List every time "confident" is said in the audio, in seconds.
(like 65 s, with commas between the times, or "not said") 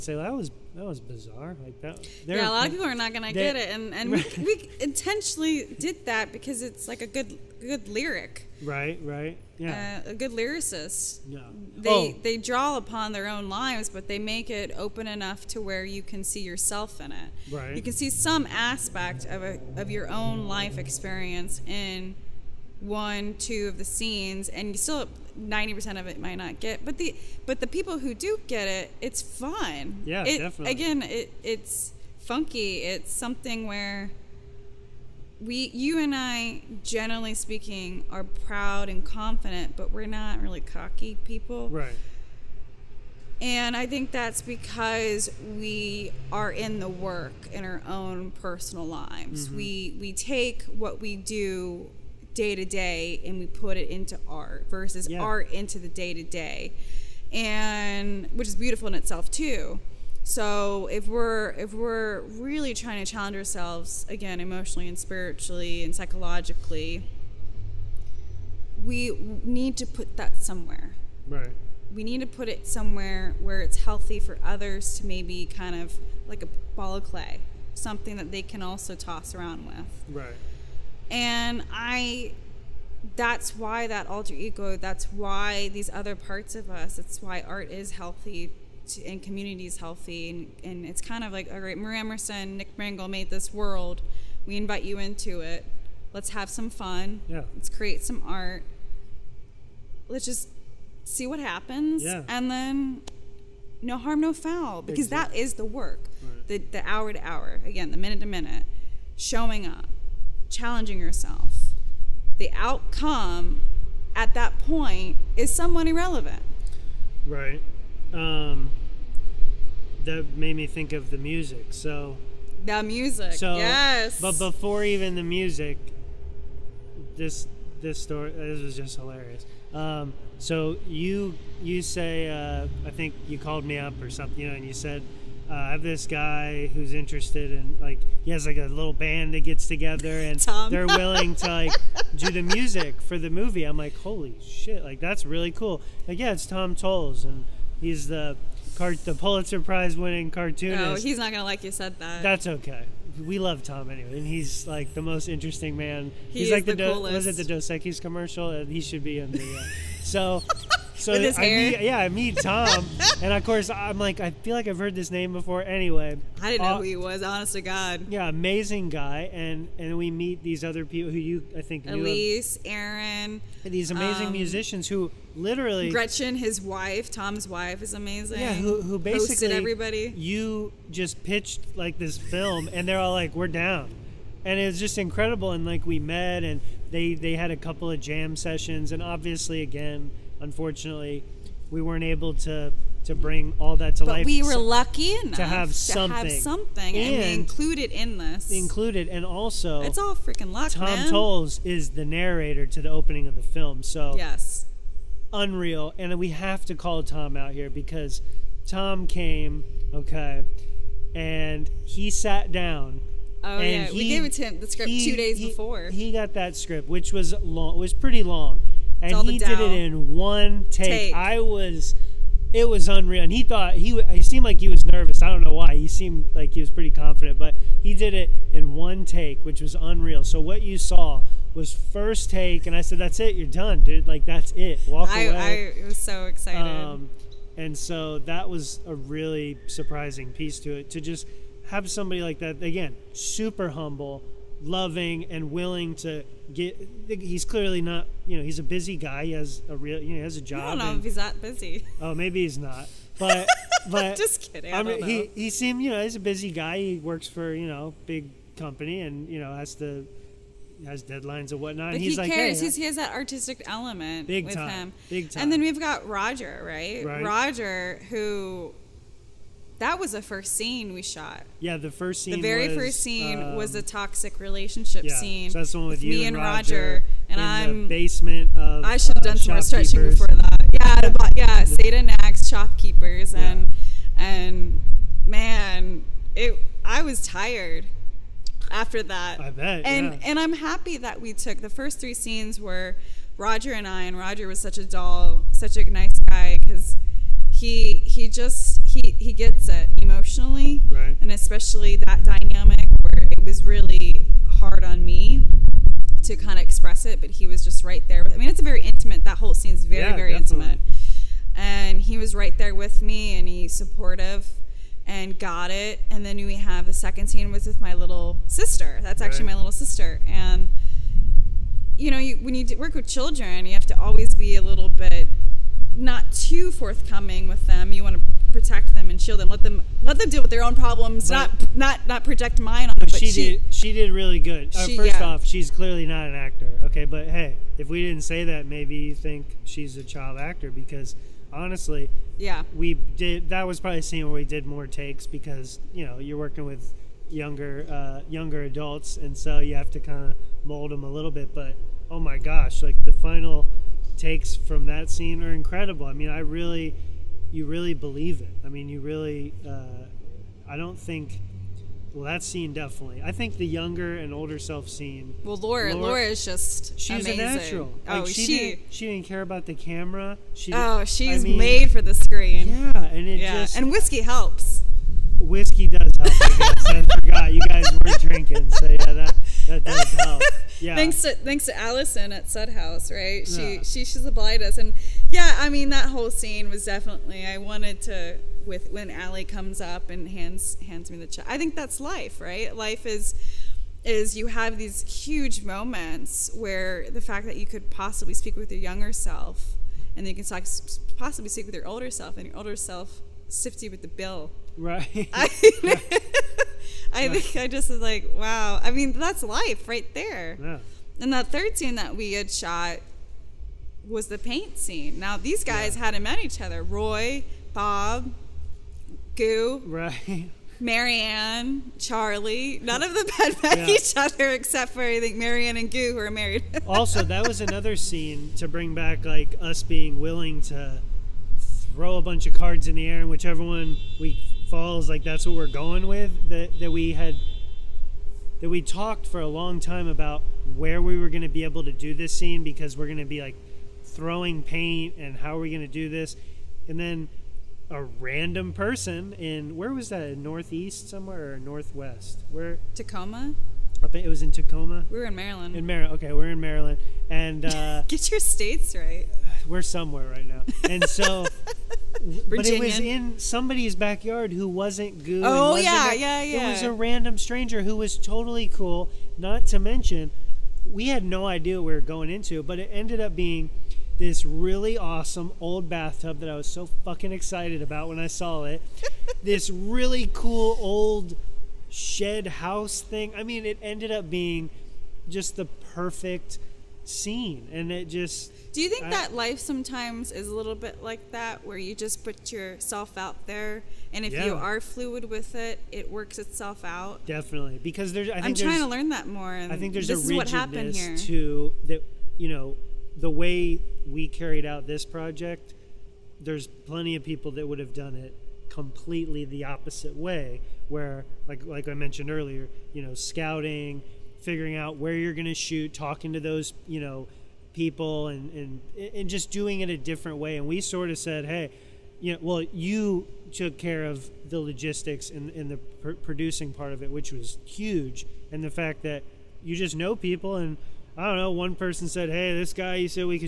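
39 s, 226 s.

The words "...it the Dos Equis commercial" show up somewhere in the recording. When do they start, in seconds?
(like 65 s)
157 s.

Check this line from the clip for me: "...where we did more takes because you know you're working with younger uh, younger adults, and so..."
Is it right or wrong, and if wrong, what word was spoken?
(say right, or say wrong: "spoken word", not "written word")
right.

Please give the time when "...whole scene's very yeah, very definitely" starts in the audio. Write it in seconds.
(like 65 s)
309 s.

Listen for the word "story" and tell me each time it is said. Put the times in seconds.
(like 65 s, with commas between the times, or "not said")
128 s.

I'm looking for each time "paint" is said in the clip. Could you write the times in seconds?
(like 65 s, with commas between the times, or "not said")
414 s, 444 s.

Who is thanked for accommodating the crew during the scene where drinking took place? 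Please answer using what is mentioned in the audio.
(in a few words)
Allison.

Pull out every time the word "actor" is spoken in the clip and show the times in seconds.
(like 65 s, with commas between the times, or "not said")
336 s, 340 s.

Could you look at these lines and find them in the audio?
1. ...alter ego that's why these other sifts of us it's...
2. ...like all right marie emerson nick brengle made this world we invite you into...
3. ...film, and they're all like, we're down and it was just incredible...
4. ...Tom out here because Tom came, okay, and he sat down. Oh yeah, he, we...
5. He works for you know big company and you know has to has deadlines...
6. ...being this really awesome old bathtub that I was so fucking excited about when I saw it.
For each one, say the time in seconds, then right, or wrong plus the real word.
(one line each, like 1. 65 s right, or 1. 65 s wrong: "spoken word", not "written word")
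1. 84 s wrong: "parts", not "sifts"
2. 91 s right
3. 182 s right
4. 207 s right
5. 256 s right
6. 473 s right.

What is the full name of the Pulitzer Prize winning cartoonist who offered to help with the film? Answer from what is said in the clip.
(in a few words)
Tom Toles.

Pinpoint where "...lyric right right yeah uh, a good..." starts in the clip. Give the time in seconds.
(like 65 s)
7 s.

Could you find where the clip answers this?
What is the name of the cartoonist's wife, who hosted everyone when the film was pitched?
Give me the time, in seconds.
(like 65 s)
175 s.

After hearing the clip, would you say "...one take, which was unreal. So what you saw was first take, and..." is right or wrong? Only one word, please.
right.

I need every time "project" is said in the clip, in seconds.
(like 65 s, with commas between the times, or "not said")
332 s, 505 s.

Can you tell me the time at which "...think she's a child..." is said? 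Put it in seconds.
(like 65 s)
339 s.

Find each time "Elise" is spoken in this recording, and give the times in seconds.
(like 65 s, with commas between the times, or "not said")
171 s.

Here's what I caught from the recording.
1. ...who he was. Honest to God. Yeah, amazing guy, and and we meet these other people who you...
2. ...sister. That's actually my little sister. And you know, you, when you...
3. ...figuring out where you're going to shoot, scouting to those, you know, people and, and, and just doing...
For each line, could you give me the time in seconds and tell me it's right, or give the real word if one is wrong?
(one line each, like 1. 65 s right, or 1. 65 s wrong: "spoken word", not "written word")
1. 166 s right
2. 318 s right
3. 514 s wrong: "talking", not "scouting".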